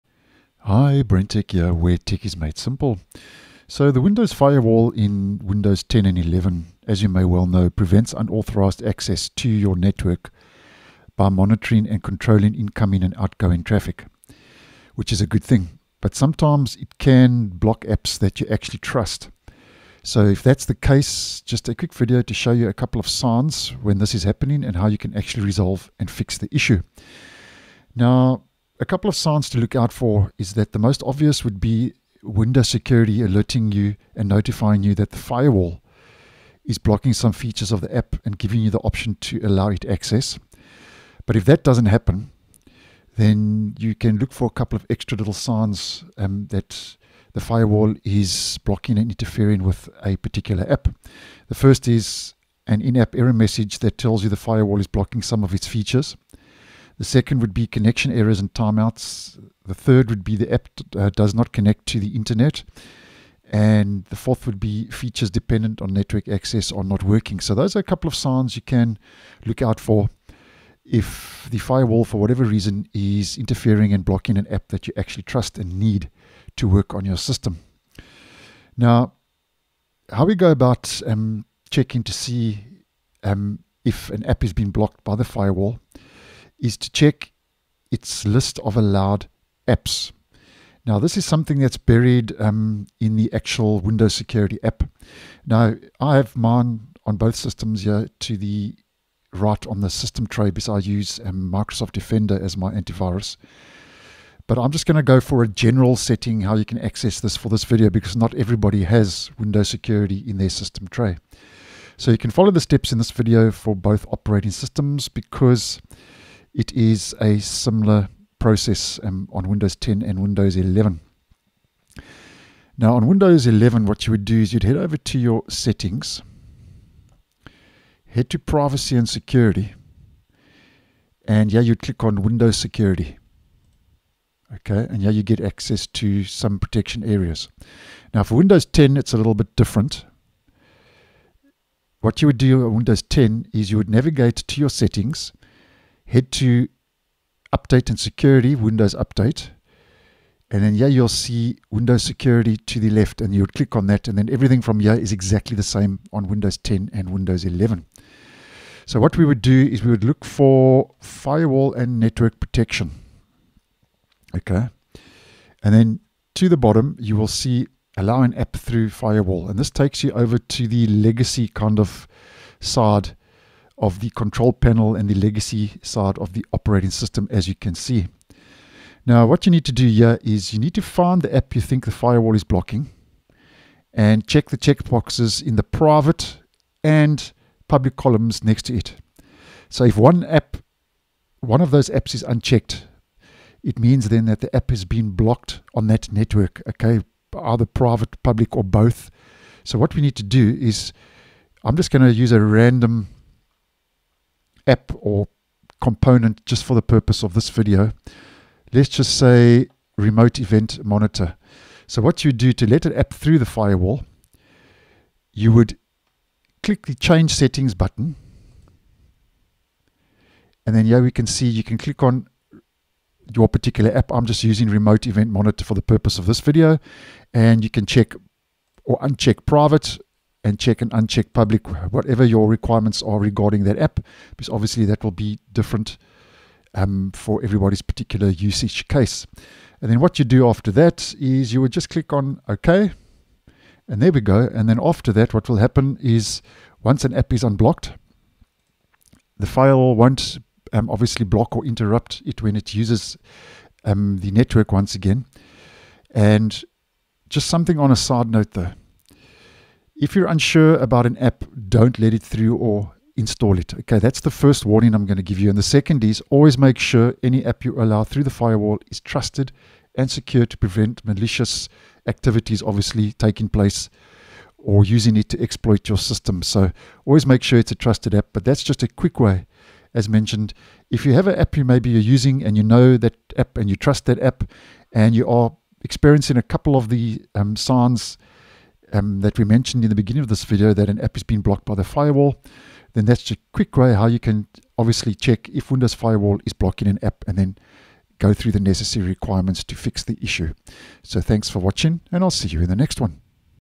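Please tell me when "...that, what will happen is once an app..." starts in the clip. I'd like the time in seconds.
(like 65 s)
245 s.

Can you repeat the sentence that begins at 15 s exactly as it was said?
But sometimes it can block apps that you actually trust.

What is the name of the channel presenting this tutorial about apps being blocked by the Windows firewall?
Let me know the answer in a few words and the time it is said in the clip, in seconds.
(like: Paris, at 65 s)
BrenTech, at 1 s.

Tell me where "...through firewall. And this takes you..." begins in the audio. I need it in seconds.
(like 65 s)
168 s.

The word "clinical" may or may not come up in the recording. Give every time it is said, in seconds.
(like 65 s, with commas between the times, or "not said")
not said.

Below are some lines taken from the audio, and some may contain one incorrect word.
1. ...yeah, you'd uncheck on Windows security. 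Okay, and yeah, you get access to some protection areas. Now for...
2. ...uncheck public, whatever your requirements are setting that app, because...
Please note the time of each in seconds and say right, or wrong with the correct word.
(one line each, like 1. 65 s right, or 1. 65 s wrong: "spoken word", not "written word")
1. 131 s wrong: "click", not "uncheck"
2. 230 s wrong: "regarding", not "setting".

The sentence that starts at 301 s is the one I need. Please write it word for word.
So thanks for watching and I'll see you in the next one.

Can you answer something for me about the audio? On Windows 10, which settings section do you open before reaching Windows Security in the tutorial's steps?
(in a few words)
Update and security.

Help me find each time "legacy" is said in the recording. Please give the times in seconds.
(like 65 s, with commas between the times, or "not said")
170 s, 175 s.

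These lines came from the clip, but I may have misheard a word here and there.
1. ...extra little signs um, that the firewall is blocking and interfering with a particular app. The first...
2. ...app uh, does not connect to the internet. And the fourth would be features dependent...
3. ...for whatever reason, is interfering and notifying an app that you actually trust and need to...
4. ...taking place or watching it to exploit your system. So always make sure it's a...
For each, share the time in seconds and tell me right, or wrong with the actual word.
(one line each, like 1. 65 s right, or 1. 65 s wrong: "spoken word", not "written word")
1. 44 s right
2. 60 s right
3. 72 s wrong: "blocking", not "notifying"
4. 273 s wrong: "using", not "watching".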